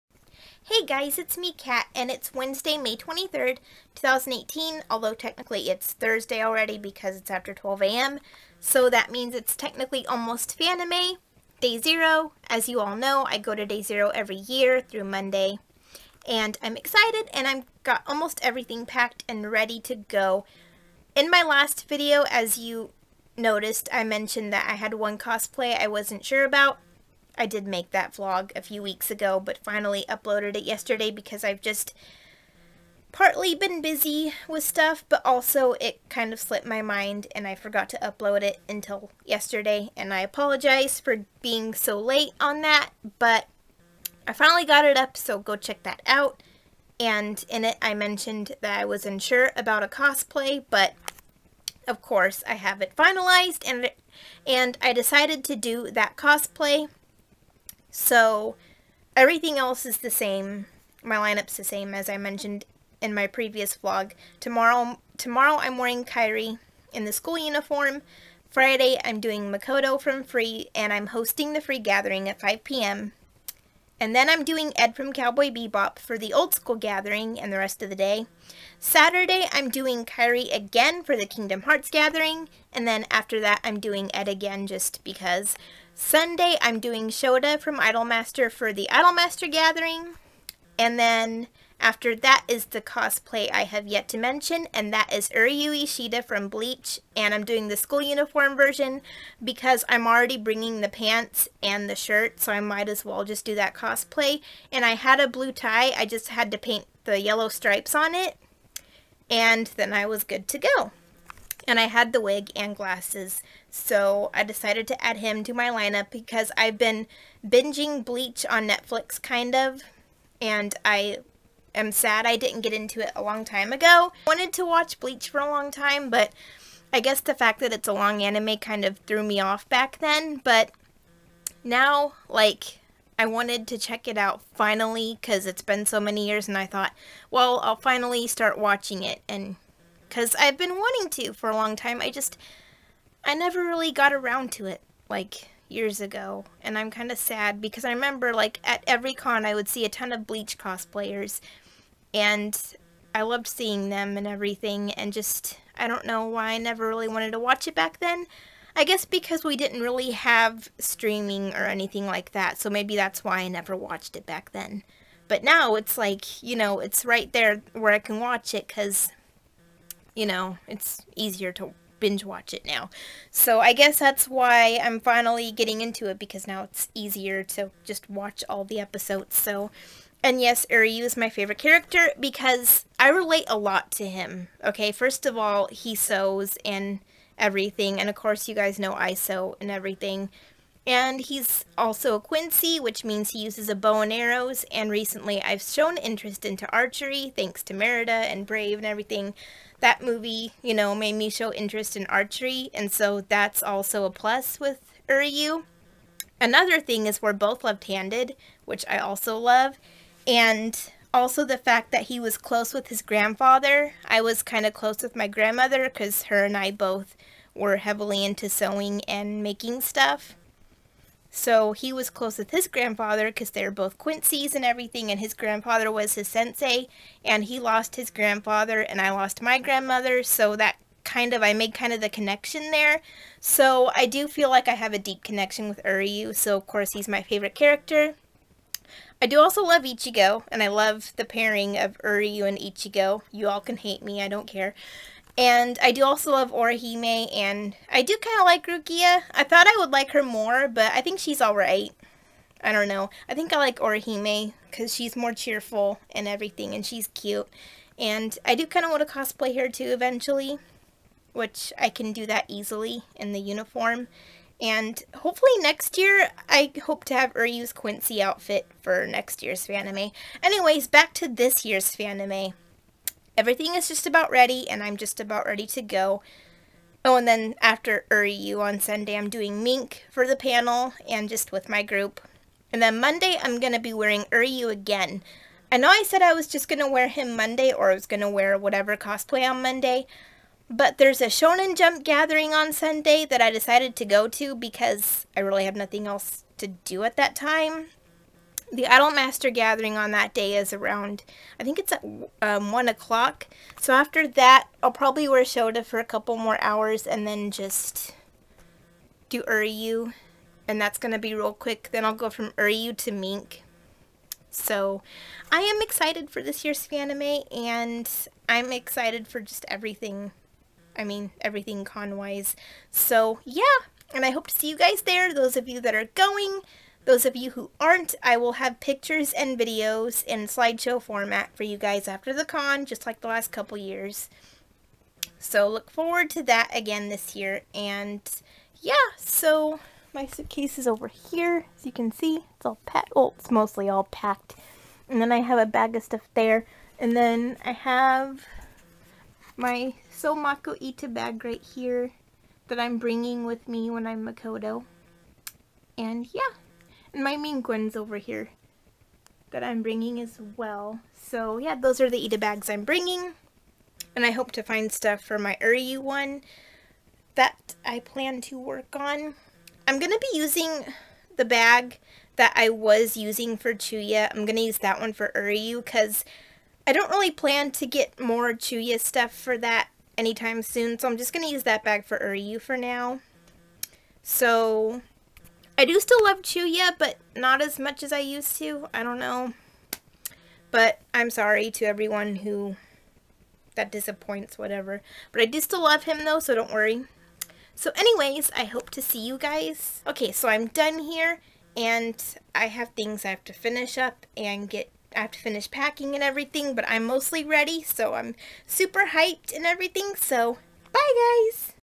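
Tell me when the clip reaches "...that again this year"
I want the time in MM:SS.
05:36.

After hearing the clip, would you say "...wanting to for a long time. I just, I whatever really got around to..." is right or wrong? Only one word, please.
wrong.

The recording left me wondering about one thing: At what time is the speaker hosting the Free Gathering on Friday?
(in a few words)
5 p.m.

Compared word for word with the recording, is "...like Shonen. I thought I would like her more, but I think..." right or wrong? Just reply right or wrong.
wrong.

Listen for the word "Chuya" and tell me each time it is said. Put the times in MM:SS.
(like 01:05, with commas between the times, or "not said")
06:13, 06:18, 06:26.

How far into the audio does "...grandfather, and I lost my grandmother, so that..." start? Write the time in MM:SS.
03:48.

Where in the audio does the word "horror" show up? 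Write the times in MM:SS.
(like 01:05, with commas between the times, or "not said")
not said.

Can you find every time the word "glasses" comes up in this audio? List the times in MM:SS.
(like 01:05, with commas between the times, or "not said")
01:52.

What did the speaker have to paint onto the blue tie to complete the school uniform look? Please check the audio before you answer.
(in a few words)
Yellow stripes.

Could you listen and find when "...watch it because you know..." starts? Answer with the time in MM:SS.
02:48.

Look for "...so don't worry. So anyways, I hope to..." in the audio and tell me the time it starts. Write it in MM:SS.
06:36.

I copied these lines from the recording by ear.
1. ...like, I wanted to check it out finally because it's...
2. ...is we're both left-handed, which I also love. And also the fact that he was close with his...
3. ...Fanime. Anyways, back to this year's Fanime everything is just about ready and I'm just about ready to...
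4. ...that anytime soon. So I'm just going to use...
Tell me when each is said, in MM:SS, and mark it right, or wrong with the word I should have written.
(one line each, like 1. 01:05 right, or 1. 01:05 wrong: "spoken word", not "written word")
1. 02:12 right
2. 03:27 right
3. 04:29 right
4. 06:19 right.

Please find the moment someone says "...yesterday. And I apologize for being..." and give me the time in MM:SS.
00:39.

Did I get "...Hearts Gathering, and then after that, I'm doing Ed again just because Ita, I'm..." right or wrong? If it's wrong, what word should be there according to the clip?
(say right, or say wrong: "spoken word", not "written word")
wrong: "Sunday", not "Ita".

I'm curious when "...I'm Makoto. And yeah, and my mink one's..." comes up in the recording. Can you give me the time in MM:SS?
05:54.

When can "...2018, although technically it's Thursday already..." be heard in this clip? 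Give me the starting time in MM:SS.
00:03.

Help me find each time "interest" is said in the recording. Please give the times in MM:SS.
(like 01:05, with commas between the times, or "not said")
03:15, 03:21.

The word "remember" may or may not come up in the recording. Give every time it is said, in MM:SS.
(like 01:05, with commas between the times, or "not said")
02:27.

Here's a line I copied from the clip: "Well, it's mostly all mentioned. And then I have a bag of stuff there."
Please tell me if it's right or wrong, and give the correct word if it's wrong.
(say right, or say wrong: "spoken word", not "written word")
wrong: "packed", not "mentioned".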